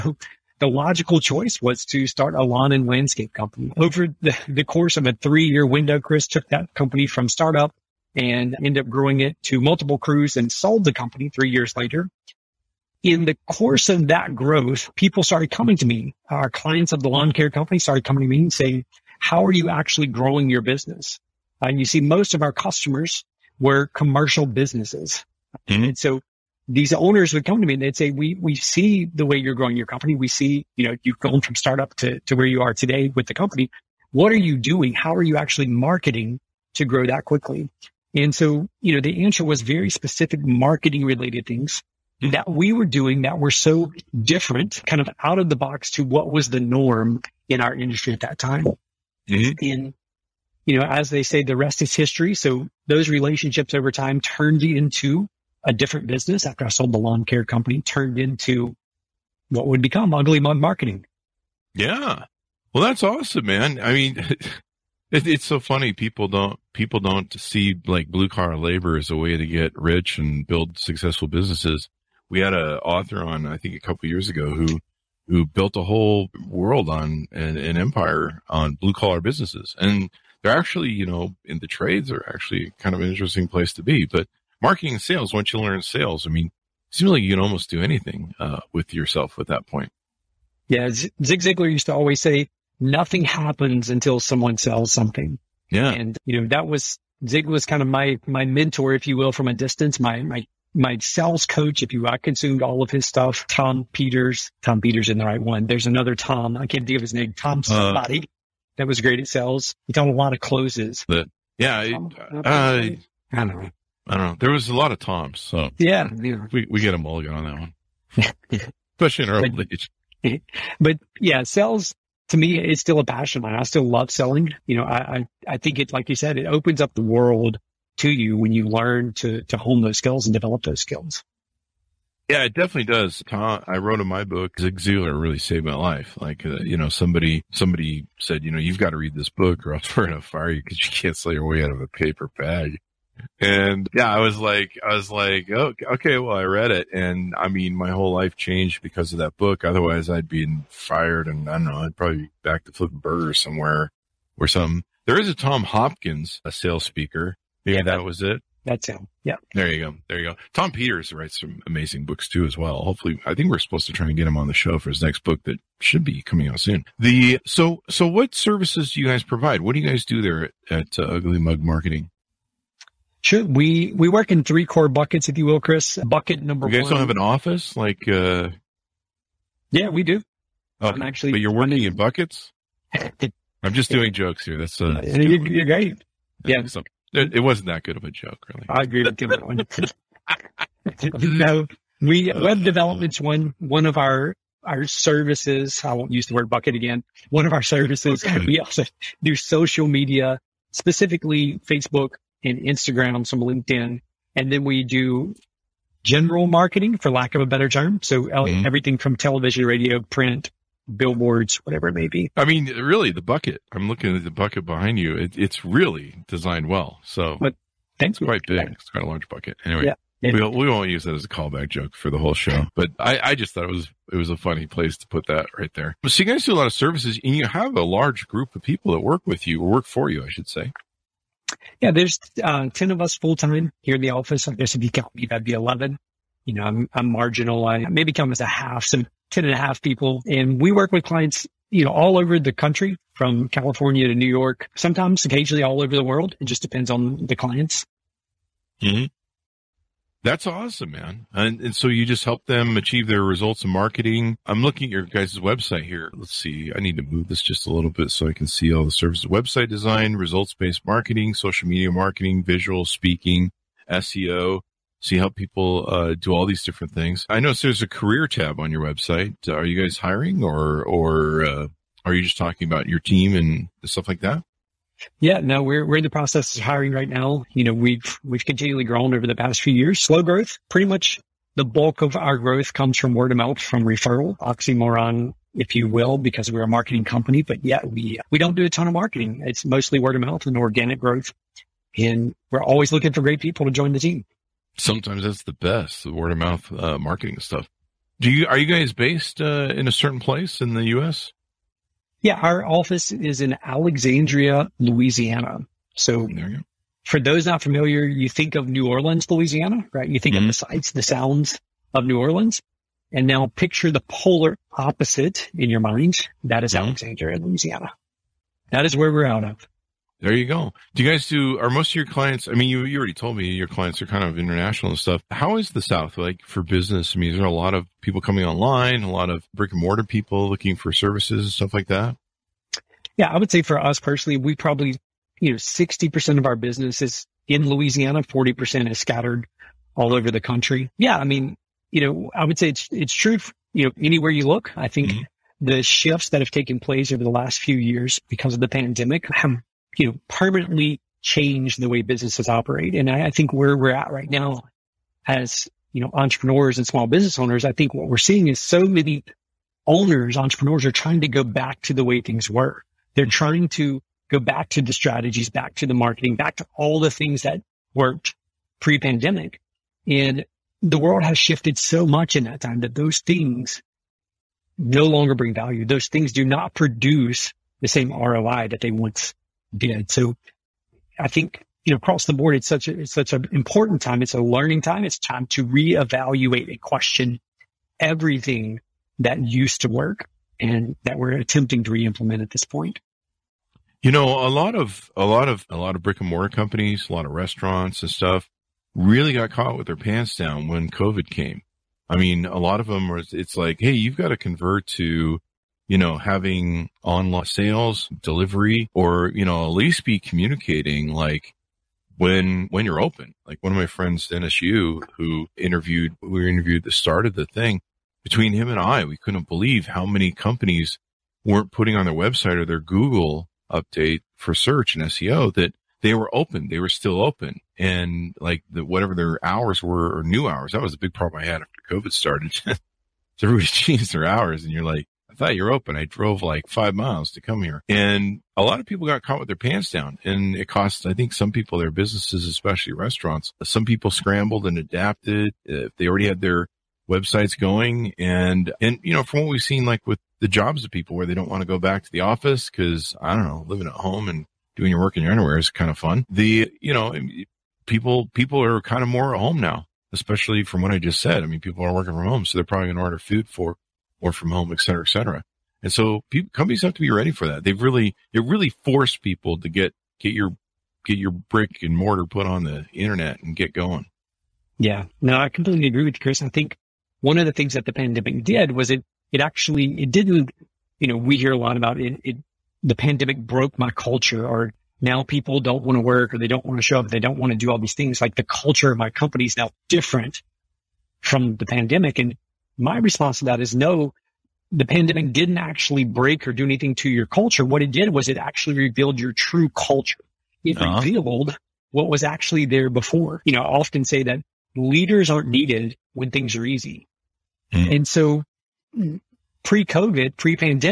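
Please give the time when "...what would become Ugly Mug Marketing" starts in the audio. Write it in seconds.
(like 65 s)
59 s.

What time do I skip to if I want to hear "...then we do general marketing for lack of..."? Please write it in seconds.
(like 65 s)
204 s.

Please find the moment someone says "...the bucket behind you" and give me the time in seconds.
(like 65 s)
214 s.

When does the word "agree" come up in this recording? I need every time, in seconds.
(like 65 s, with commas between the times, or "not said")
188 s, 475 s.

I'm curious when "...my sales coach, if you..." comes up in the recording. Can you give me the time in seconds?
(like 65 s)
100 s.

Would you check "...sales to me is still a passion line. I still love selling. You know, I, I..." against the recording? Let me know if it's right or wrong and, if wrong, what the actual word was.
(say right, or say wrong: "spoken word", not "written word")
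right.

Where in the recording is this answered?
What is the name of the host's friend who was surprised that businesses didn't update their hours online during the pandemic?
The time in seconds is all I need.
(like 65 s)
414 s.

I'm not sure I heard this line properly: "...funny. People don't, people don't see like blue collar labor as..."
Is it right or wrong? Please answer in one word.
right.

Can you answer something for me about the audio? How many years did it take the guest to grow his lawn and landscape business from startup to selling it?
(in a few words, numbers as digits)
3.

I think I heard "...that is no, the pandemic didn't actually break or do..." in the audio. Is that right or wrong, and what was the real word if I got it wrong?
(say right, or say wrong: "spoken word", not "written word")
right.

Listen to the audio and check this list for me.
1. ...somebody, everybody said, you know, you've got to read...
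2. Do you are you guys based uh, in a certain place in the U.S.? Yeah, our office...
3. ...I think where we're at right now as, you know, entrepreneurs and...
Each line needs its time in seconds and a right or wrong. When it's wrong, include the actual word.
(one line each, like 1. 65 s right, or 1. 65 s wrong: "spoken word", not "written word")
1. 136 s wrong: "somebody", not "everybody"
2. 298 s right
3. 353 s right.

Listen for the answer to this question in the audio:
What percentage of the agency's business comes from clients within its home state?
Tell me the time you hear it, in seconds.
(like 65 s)
335 s.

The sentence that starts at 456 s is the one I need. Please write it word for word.
The, you know, people, people are kind of more at home now, especially from what I just said.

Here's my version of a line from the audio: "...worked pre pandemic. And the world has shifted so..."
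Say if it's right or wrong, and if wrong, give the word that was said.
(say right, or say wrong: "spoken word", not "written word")
right.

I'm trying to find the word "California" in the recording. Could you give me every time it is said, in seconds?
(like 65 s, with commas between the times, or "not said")
243 s.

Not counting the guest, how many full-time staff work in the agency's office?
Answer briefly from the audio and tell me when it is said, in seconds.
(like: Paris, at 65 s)
10, at 232 s.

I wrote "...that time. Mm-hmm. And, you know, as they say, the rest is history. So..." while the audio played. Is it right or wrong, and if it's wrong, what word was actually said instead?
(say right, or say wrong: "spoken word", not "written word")
right.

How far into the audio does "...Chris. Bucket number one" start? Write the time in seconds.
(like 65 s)
175 s.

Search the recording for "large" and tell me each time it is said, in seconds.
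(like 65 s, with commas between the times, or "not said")
219 s, 227 s.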